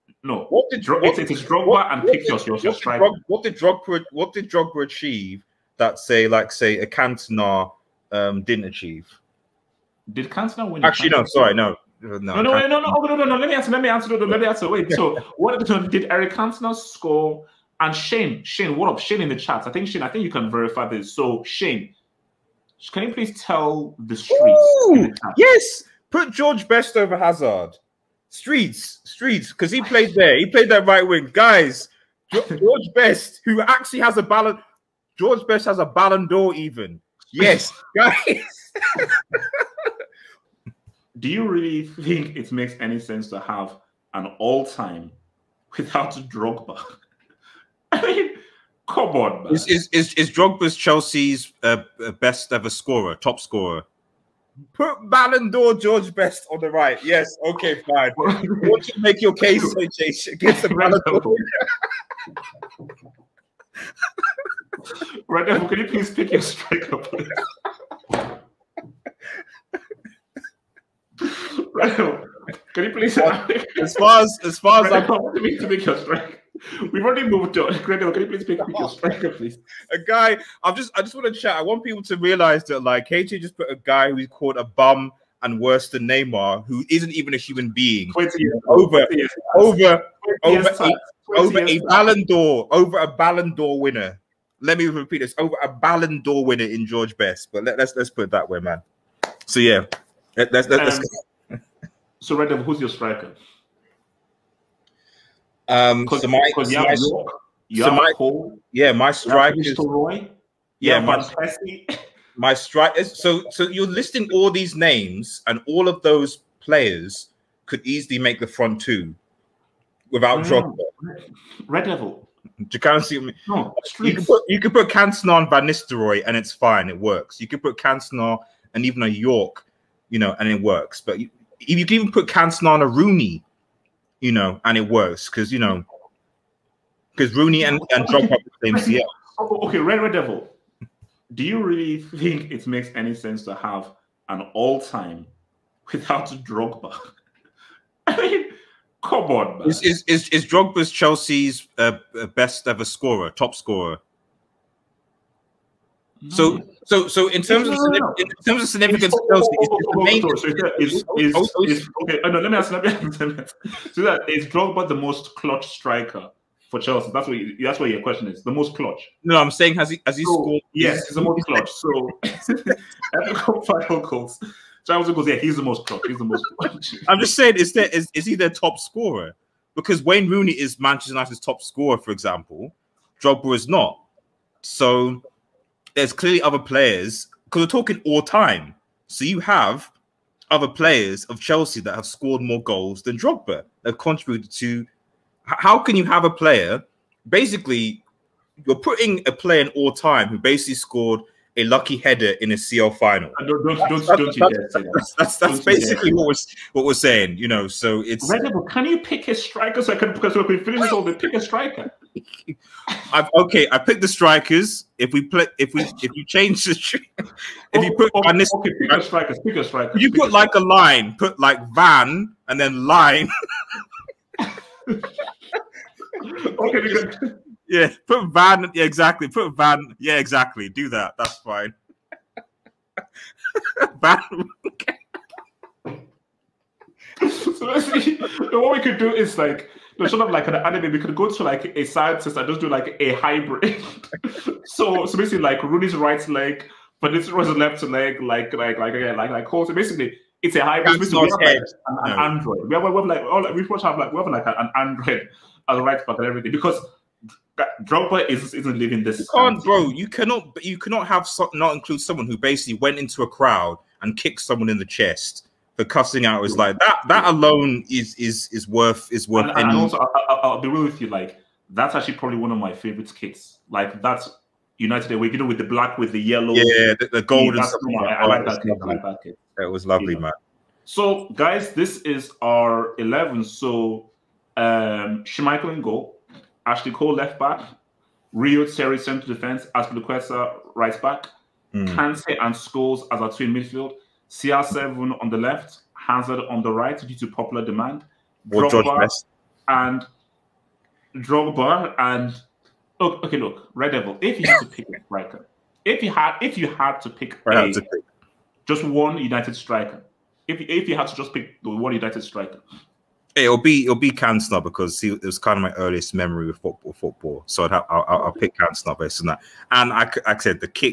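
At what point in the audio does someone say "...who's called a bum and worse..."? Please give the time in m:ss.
1:24.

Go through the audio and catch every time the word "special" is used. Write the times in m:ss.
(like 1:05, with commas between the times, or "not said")
not said.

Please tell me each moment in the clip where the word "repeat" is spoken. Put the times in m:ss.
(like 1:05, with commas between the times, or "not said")
1:34.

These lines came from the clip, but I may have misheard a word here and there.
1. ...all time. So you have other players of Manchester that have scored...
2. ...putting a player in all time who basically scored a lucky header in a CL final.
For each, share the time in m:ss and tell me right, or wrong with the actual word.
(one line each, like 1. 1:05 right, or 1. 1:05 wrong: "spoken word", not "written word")
1. 3:08 wrong: "Chelsea", not "Manchester"
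2. 3:18 right.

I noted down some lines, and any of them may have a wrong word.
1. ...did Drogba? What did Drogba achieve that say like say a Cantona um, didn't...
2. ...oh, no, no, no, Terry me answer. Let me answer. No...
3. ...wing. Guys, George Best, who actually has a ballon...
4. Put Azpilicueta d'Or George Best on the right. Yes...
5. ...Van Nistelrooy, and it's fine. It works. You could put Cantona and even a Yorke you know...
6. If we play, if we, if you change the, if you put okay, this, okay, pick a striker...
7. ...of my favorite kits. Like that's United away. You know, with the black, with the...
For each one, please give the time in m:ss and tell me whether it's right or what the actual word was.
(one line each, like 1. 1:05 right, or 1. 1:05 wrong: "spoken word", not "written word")
1. 0:03 right
2. 0:12 wrong: "Let", not "Terry"
3. 0:31 right
4. 0:54 wrong: "Ballon", not "Azpilicueta"
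5. 2:05 right
6. 3:34 right
7. 4:32 right.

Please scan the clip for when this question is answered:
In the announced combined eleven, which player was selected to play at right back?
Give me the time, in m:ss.
4:49.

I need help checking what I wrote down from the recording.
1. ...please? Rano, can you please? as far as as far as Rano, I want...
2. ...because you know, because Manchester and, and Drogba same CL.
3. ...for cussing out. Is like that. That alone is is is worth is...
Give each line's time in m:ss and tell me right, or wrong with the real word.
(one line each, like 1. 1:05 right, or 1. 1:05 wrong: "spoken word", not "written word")
1. 1:06 right
2. 2:15 wrong: "Rooney", not "Manchester"
3. 4:25 right.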